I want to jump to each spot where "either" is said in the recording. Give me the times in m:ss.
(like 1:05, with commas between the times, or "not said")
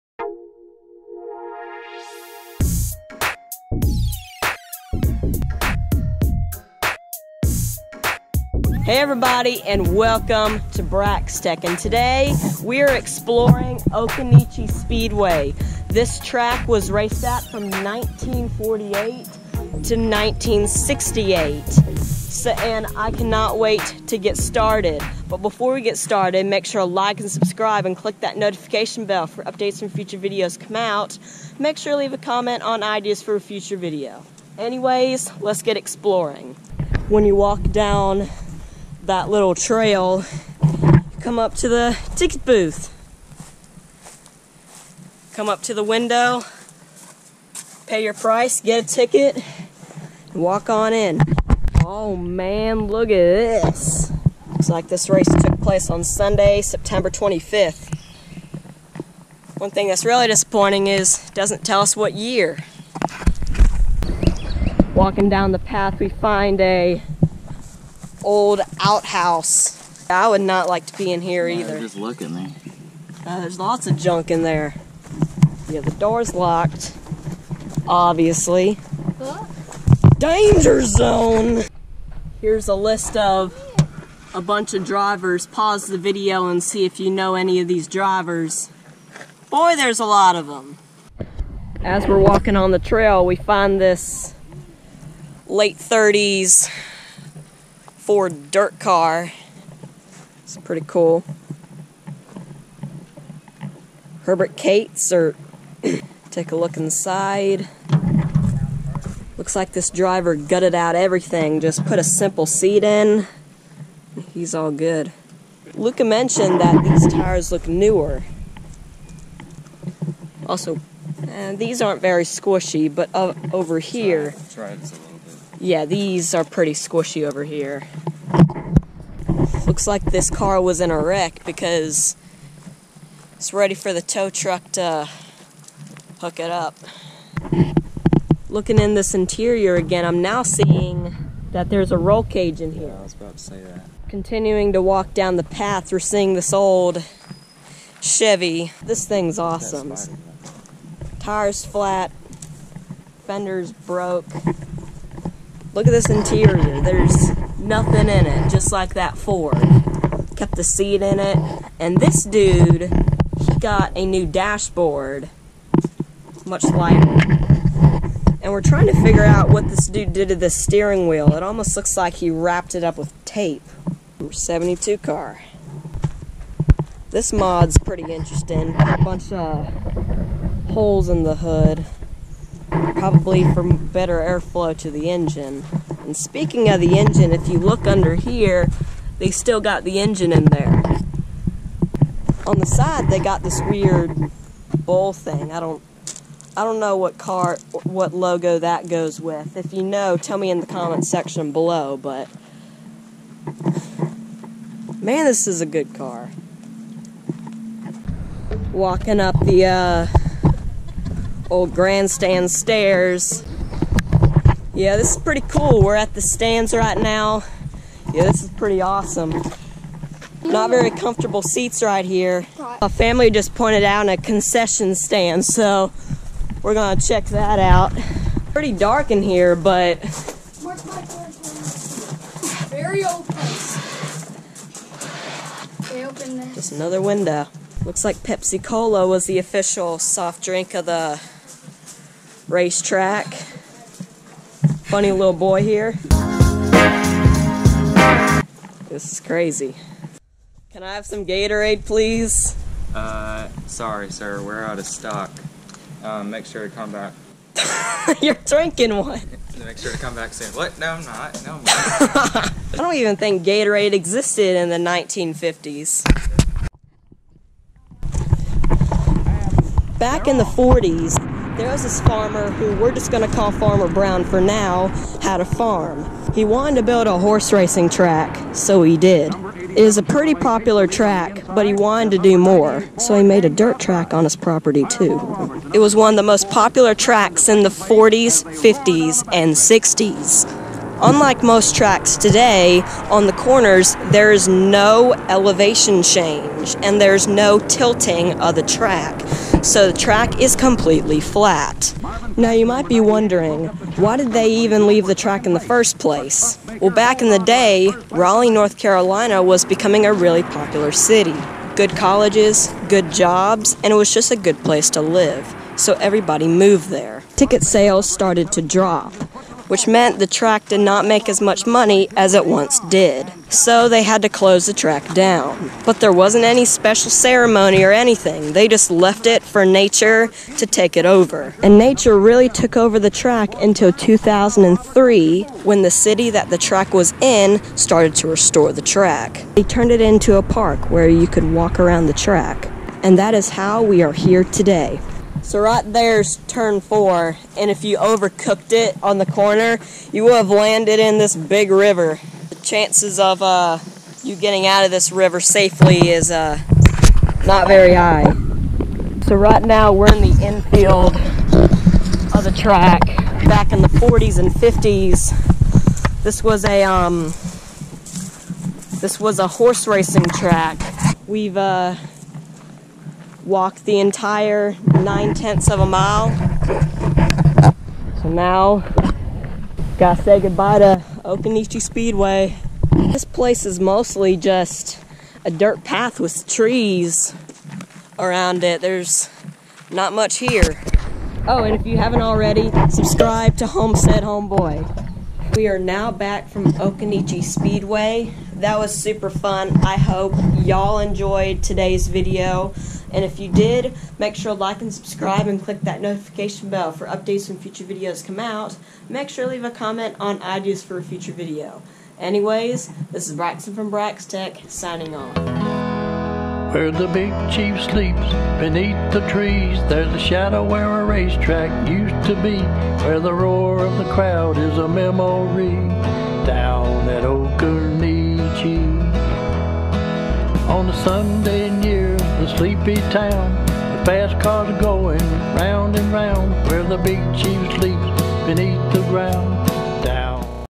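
1:11.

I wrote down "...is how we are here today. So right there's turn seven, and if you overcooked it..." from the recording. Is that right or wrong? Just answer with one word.
wrong.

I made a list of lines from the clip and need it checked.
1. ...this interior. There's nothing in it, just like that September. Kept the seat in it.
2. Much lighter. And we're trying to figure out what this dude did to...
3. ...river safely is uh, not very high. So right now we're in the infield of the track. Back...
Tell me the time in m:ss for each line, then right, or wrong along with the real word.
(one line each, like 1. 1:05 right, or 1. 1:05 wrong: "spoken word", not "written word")
1. 2:35 wrong: "Ford", not "September"
2. 2:46 right
3. 5:55 right.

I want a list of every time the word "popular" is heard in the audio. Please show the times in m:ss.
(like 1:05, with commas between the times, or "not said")
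4:40, 4:46, 5:10.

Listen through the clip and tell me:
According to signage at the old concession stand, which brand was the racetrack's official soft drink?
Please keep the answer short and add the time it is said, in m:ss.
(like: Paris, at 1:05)
Pepsi Cola, at 3:58.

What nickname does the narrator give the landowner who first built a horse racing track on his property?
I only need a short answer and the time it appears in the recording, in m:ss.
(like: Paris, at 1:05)
Farmer Brown, at 4:33.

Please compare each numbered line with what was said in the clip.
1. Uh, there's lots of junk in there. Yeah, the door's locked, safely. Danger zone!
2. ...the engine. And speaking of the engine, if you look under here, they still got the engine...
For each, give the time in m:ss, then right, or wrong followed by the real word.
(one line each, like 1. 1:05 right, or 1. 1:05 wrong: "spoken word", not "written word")
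1. 1:13 wrong: "obviously", not "safely"
2. 3:04 right.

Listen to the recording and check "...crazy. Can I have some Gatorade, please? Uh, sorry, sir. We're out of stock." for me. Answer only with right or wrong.
right.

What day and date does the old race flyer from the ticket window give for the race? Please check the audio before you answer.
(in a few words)
Sunday, September 25th.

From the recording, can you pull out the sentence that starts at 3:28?
Walking up the uh old grandstand stairs.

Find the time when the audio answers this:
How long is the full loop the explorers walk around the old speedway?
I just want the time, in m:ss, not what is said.
6:14.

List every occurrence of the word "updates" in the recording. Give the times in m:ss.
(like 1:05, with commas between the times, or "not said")
0:29, 6:47.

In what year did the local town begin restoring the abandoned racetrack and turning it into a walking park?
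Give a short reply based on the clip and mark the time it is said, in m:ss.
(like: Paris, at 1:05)
2003, at 5:33.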